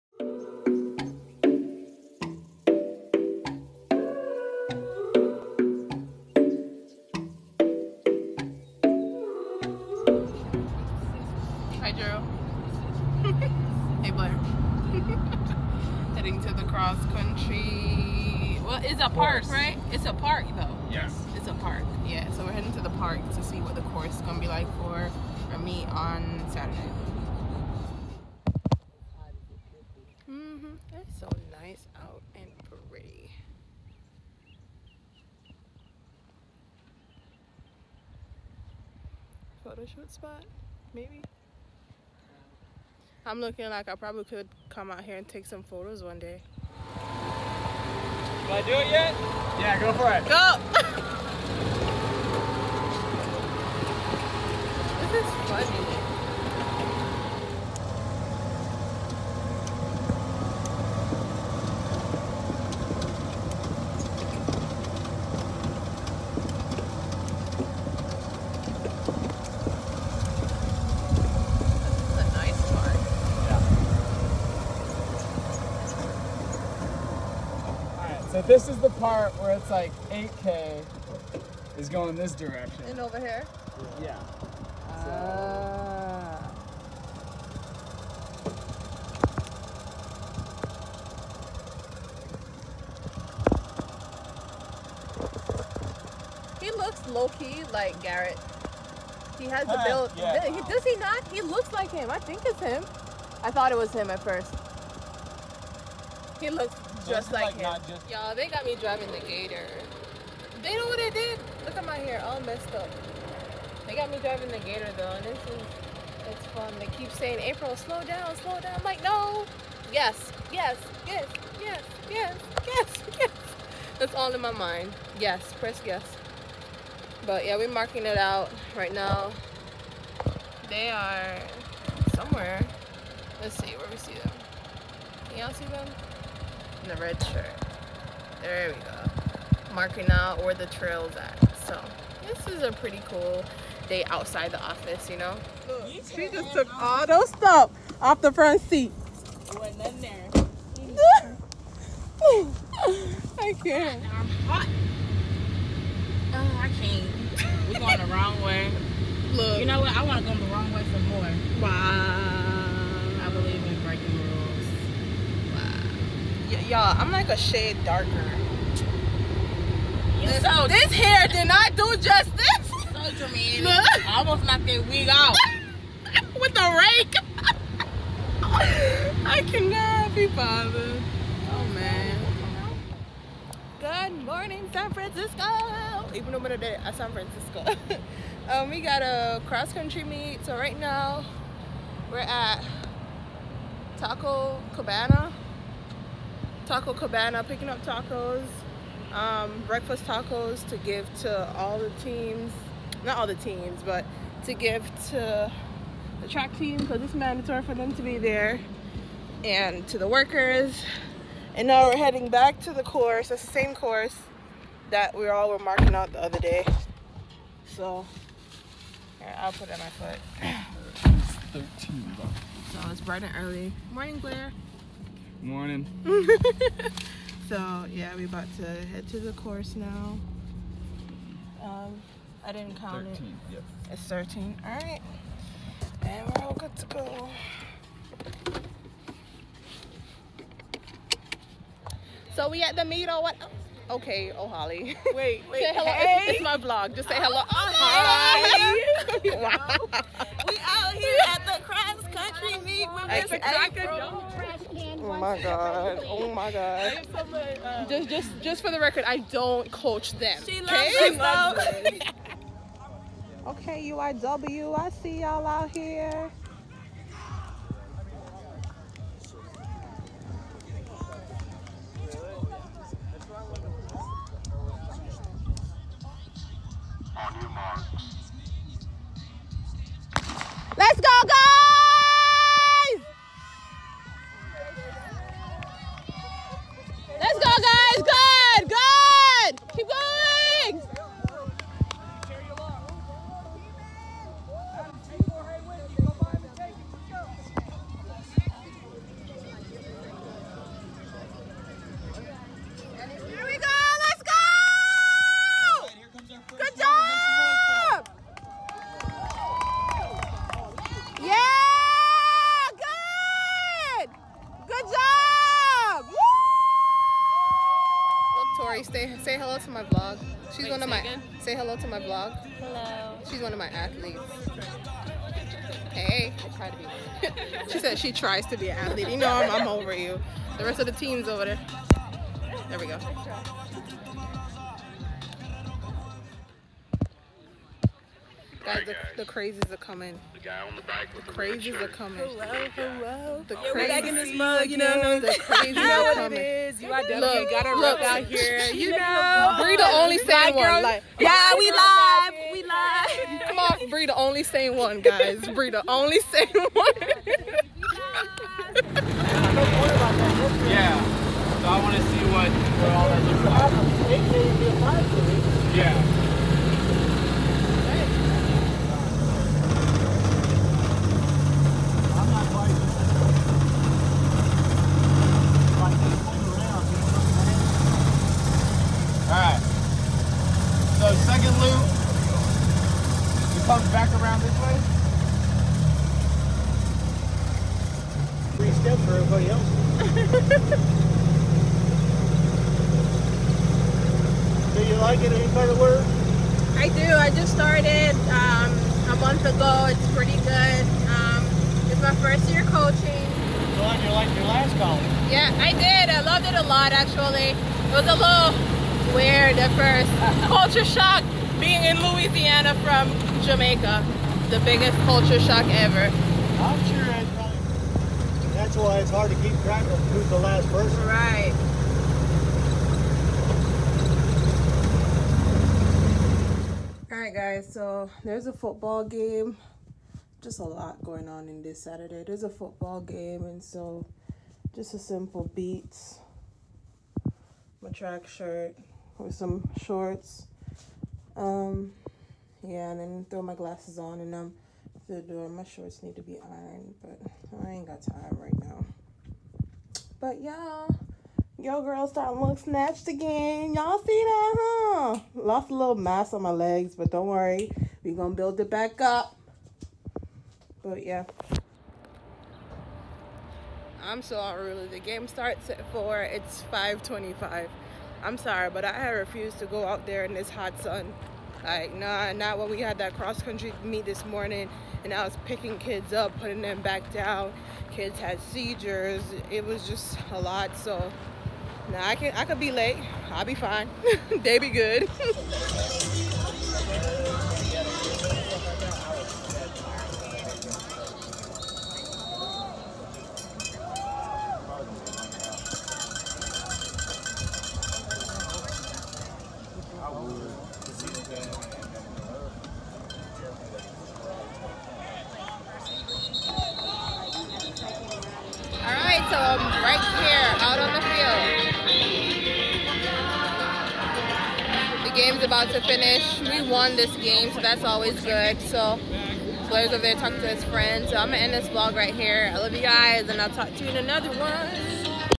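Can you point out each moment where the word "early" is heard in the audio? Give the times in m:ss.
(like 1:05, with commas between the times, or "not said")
3:43.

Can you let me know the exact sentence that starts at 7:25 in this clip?
My shorts need to be ironed, but I ain't got time right now.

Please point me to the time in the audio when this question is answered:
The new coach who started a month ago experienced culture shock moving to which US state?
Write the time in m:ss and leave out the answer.
6:52.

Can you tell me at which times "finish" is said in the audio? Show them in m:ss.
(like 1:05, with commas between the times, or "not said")
8:35.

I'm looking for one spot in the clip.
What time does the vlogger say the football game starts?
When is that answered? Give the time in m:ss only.
7:45.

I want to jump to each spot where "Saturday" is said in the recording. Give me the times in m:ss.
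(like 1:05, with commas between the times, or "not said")
0:26, 7:11.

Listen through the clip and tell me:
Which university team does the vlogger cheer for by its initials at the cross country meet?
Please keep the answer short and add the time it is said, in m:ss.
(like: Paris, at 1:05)
UIW, at 4:23.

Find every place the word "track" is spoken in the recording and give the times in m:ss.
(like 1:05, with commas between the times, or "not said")
3:26, 6:59, 7:17.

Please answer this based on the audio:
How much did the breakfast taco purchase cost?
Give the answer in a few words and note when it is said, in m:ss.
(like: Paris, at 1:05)
$13, at 3:41.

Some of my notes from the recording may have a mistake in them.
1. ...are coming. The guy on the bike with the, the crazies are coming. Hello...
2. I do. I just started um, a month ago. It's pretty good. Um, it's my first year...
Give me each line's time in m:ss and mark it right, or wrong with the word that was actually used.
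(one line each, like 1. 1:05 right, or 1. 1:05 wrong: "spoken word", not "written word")
1. 5:39 right
2. 6:36 right.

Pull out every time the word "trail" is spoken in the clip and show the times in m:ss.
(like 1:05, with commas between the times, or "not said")
2:20.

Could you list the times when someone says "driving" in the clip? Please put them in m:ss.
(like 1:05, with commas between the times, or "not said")
1:48, 1:54.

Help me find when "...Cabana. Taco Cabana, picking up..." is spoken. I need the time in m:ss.
3:14.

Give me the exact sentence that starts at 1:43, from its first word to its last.
I thought it was him at first.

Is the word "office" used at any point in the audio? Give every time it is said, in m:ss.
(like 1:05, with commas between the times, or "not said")
2:24.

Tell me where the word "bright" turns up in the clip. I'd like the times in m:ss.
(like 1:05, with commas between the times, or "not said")
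3:43.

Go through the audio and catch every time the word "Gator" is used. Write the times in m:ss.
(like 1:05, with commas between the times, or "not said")
1:49, 1:54.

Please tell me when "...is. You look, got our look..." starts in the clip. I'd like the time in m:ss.
5:46.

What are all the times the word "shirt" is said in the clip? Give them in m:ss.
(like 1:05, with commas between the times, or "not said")
2:17, 7:18.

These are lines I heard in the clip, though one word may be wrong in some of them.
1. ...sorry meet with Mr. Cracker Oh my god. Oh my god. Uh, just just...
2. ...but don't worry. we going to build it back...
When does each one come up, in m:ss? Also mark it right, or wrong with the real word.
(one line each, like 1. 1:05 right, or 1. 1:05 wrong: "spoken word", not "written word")
1. 4:12 wrong: "country", not "sorry"
2. 7:36 right.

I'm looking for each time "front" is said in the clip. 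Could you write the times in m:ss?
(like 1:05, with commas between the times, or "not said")
2:28.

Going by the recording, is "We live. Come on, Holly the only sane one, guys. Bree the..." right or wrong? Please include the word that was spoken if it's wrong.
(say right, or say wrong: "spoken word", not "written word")
wrong: "Bree", not "Holly".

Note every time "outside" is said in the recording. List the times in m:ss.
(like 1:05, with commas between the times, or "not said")
2:24.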